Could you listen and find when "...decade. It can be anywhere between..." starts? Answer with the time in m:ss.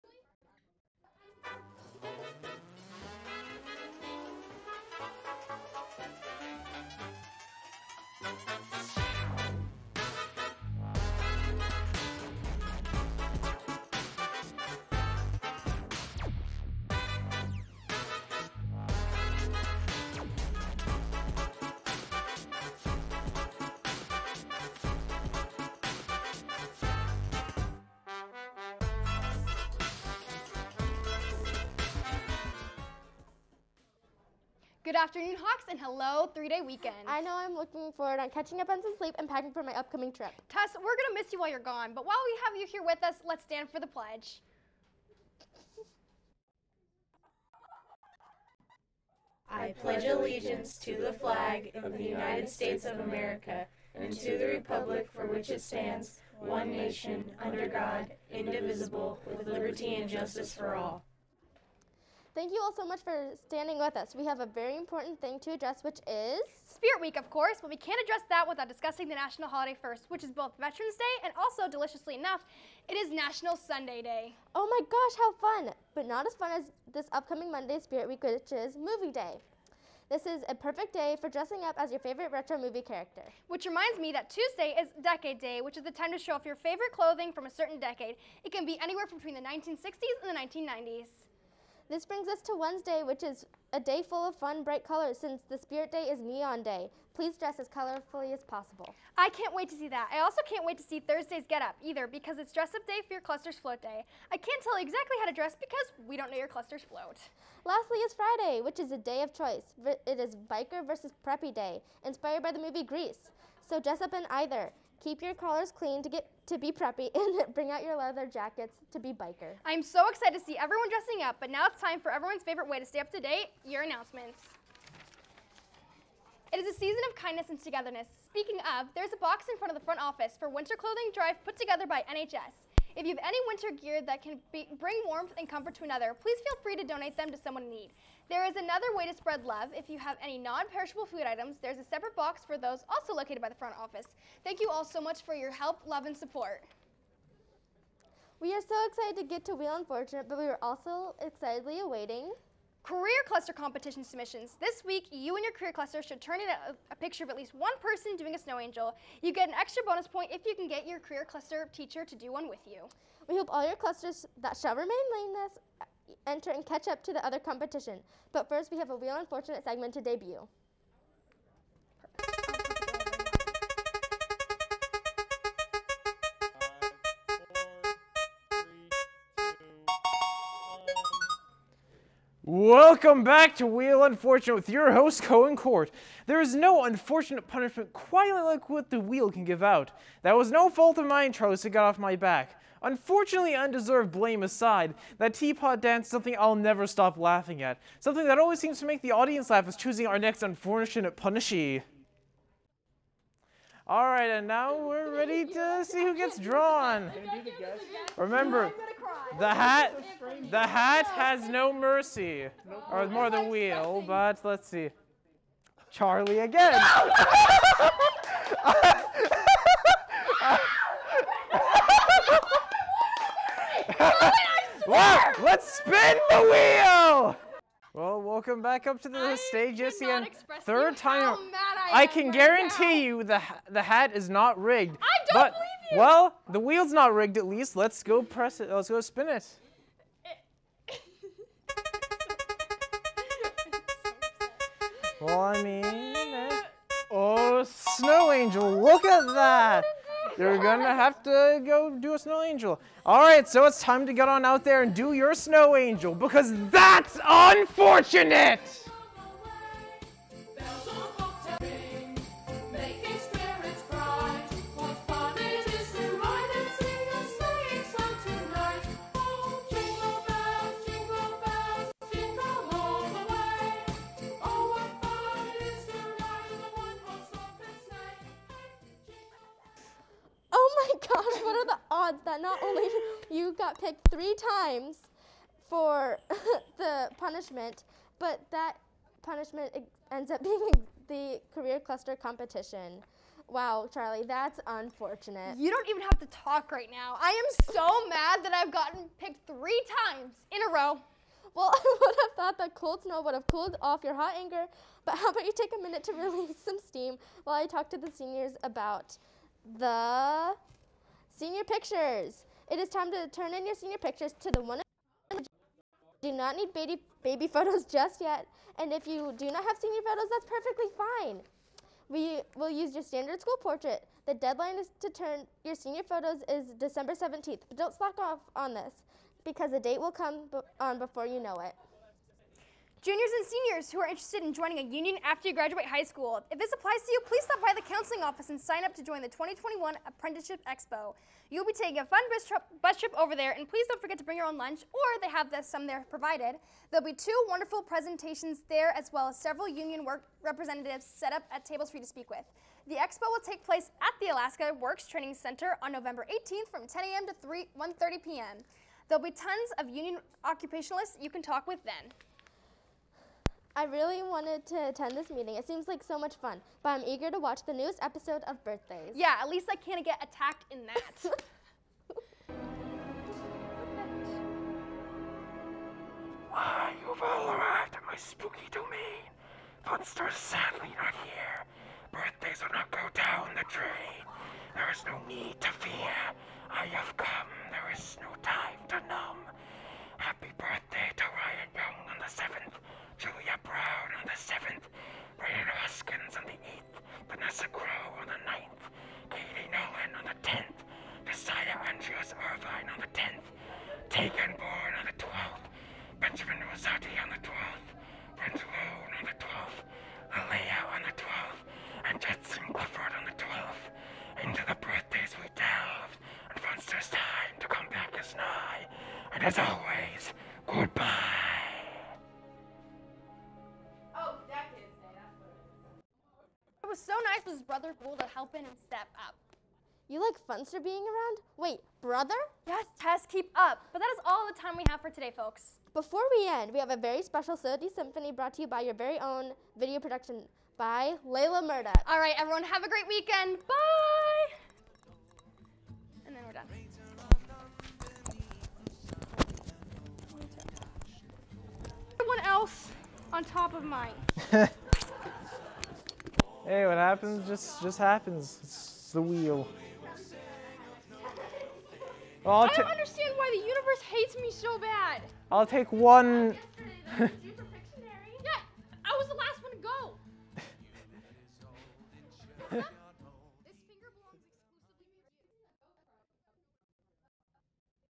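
1:27.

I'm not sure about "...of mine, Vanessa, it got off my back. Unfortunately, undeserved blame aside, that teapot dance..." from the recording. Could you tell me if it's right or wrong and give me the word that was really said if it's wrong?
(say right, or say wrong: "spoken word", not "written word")
wrong: "Charles", not "Vanessa".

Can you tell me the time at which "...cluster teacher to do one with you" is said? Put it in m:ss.
2:41.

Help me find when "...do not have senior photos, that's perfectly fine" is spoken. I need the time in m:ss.
5:19.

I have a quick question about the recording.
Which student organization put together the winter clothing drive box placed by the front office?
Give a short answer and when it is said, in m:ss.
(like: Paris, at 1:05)
NHS, at 2:12.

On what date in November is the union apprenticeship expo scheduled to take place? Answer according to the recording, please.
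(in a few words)
November 18.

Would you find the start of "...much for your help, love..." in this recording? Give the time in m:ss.
2:25.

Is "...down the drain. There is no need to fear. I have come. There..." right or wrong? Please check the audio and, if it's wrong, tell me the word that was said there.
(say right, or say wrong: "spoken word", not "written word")
right.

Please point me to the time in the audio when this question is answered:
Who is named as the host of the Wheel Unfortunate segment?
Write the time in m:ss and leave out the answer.
3:05.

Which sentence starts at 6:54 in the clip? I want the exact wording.
Into the birthdays we delved, and there's time to come back as nigh.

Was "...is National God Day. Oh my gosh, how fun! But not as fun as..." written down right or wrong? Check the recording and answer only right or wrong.
wrong.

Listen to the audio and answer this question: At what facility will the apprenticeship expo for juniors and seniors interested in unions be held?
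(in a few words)
Alaska Works Training Center.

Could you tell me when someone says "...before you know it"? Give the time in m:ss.
5:30.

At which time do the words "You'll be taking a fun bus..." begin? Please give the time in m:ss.
5:41.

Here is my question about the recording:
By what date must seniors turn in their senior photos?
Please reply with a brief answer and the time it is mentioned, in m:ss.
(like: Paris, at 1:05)
December 17, at 5:26.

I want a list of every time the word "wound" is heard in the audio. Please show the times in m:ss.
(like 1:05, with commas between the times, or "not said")
not said.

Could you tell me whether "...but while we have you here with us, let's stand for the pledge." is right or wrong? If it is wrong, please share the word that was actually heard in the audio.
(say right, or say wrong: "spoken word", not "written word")
right.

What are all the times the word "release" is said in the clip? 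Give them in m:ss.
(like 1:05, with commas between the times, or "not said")
5:06.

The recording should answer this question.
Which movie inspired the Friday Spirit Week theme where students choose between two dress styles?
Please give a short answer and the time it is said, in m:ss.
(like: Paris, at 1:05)
Grease, at 1:52.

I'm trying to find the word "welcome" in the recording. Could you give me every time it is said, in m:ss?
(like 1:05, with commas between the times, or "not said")
3:02, 3:48.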